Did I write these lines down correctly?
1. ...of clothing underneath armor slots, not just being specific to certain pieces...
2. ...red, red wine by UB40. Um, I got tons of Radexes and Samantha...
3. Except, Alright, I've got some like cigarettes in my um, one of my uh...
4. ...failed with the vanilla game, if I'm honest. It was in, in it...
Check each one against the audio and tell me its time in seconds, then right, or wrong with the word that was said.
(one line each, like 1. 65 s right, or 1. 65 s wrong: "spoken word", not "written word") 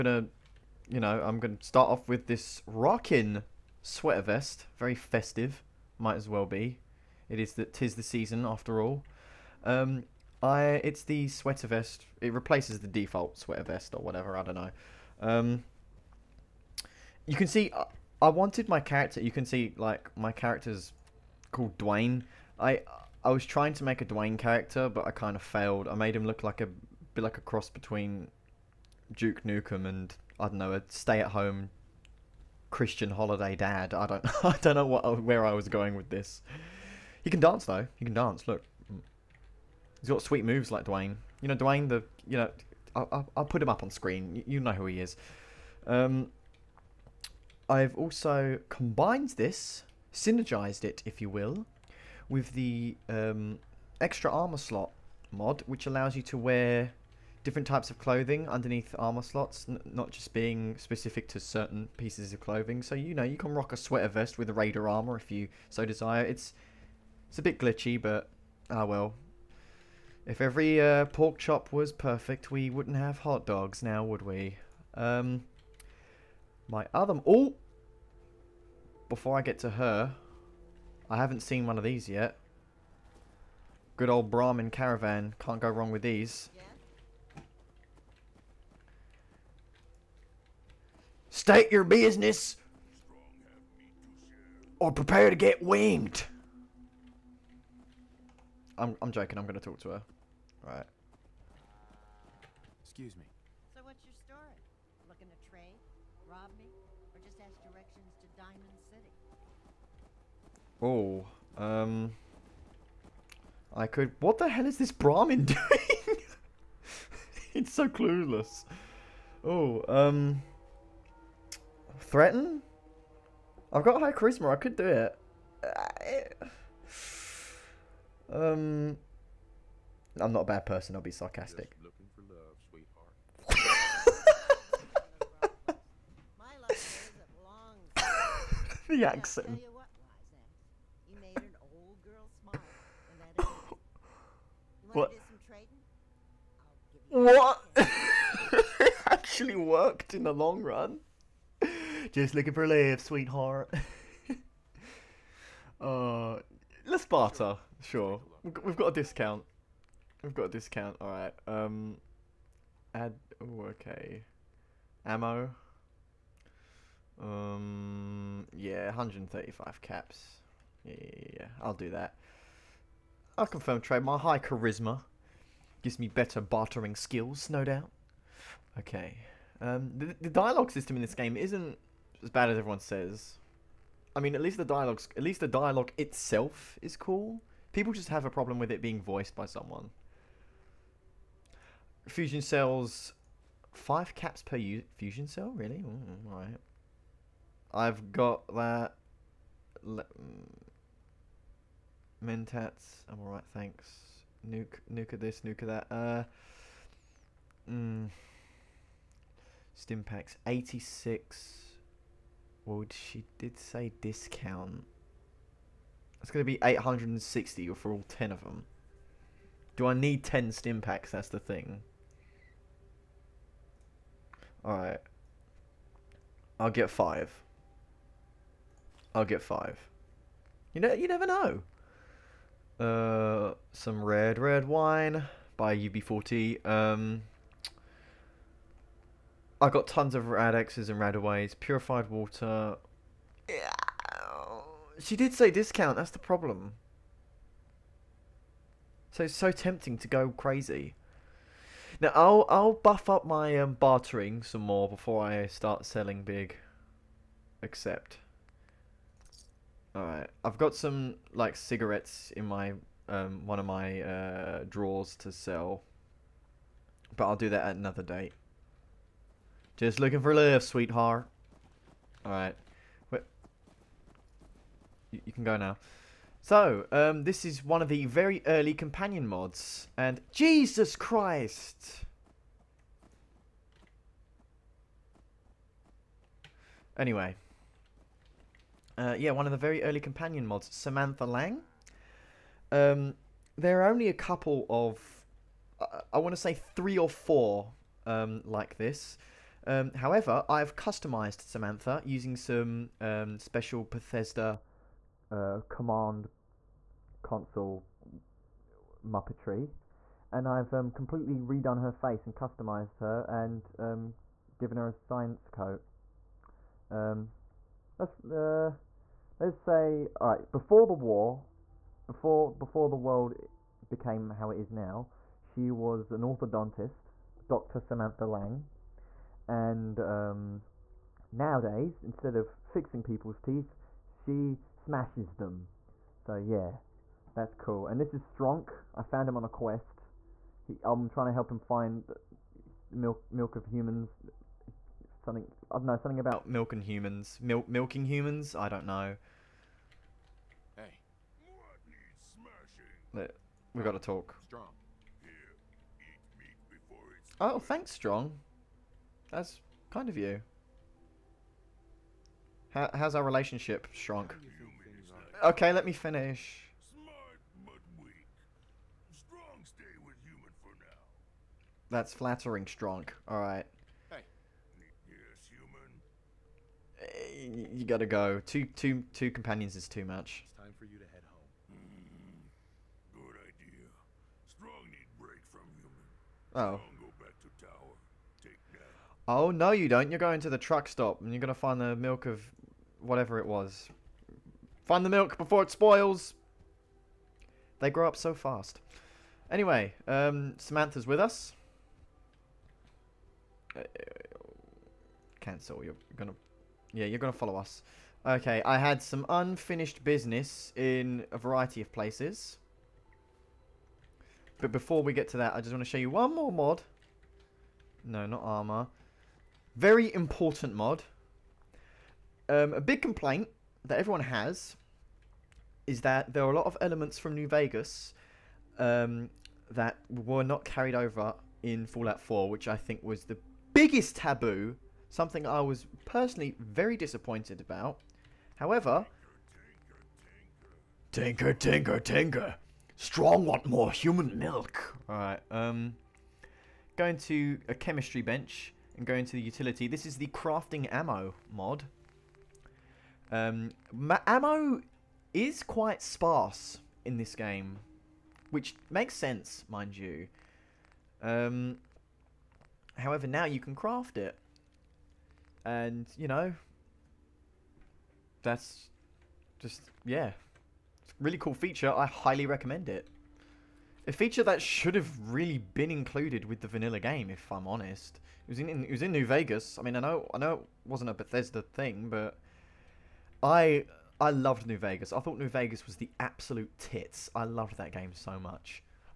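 1. 57 s right
2. 234 s wrong: "Radaways", not "Samantha"
3. 257 s right
4. 475 s wrong: "included", not "failed".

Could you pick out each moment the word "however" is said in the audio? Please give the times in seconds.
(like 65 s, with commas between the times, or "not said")
299 s, 438 s, 462 s.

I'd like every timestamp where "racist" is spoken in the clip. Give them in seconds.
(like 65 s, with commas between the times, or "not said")
not said.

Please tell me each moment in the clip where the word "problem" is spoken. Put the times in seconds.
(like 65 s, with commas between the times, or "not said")
188 s, 246 s.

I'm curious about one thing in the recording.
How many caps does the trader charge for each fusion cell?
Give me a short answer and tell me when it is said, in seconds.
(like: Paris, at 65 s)
5, at 193 s.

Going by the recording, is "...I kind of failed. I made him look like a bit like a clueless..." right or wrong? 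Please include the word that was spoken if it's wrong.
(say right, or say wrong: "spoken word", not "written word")
wrong: "cross", not "clueless".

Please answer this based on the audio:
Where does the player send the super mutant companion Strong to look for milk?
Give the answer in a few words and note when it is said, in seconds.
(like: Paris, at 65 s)
The truck stop, at 390 s.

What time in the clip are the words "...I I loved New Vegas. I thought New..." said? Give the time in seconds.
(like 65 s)
483 s.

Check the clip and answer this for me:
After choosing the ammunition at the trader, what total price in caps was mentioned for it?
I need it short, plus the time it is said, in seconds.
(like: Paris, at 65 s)
135 caps, at 168 s.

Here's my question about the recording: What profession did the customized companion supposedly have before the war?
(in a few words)
Orthodontist.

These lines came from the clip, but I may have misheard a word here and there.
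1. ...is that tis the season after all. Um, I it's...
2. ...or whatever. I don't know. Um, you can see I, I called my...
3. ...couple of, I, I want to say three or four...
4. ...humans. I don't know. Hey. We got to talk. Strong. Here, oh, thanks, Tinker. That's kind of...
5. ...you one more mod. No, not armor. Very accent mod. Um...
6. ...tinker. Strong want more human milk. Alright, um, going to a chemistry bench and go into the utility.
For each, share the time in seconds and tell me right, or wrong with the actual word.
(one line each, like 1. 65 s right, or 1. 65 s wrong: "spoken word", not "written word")
1. 7 s right
2. 13 s wrong: "wanted", not "called"
3. 294 s right
4. 348 s wrong: "Strong", not "Tinker"
5. 415 s wrong: "important", not "accent"
6. 441 s right.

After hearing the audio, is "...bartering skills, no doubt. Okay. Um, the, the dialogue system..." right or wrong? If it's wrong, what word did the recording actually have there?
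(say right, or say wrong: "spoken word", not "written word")
right.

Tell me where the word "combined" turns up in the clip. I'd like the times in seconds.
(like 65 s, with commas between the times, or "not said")
48 s.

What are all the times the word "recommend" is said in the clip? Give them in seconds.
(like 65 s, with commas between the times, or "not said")
472 s.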